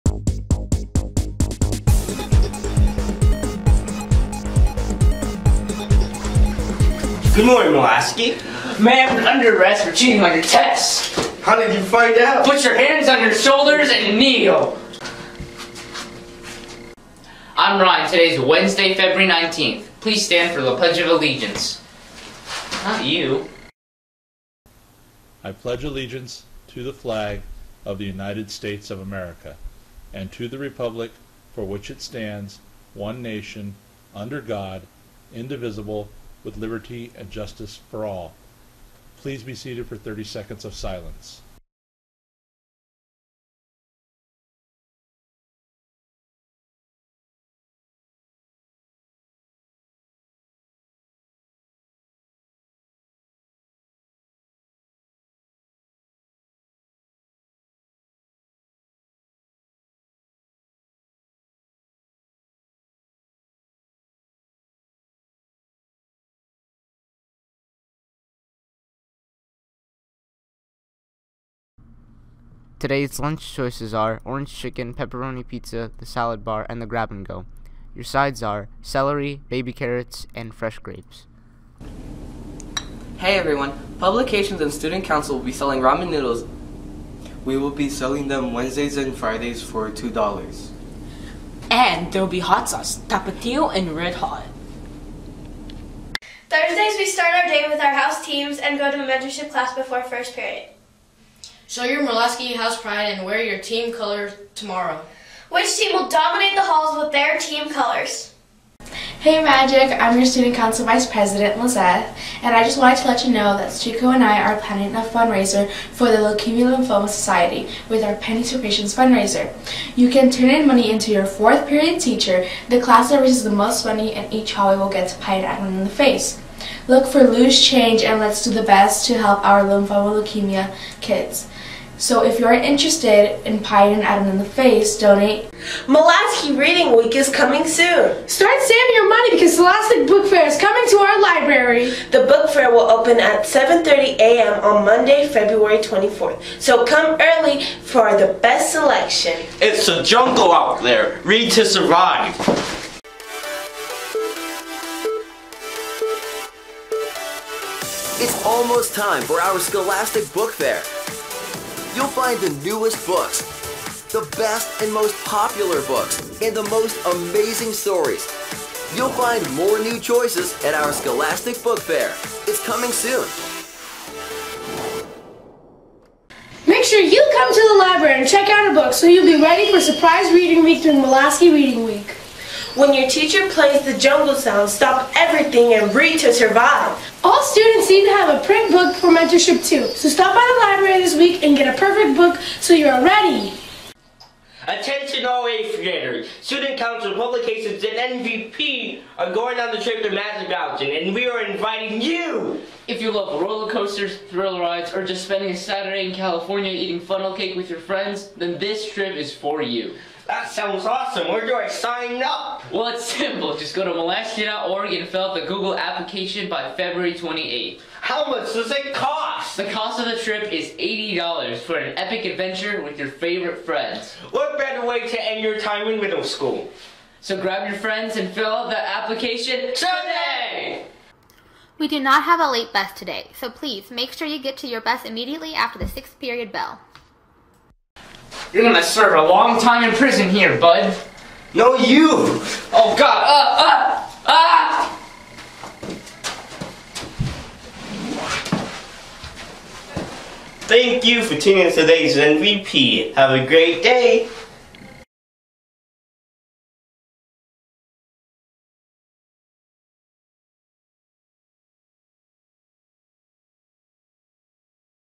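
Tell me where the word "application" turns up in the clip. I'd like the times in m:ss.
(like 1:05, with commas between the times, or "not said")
3:35, 3:48.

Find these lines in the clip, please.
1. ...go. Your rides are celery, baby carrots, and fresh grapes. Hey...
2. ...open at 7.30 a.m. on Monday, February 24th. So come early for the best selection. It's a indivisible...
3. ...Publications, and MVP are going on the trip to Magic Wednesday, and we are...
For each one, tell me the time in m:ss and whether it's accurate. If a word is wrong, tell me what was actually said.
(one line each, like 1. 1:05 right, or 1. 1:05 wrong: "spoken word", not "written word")
1. 1:17 wrong: "sides", not "rides"
2. 2:22 wrong: "jungle", not "indivisible"
3. 3:17 wrong: "Mountain", not "Wednesday".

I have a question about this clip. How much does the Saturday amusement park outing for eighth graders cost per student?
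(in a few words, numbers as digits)
$80.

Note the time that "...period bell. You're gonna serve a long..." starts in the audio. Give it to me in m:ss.
3:56.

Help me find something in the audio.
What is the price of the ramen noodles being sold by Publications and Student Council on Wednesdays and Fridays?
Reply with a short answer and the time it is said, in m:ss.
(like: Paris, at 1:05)
$2, at 1:29.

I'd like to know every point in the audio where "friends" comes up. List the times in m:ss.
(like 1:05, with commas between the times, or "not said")
3:27, 3:43, 3:47.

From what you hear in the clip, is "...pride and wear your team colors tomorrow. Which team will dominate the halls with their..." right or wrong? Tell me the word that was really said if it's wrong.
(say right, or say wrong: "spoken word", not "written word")
right.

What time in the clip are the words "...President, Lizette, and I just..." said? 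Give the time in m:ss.
1:51.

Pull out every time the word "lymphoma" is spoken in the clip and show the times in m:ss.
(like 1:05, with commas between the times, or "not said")
1:56, 2:09.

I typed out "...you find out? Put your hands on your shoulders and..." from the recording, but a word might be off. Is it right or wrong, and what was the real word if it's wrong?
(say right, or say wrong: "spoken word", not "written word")
right.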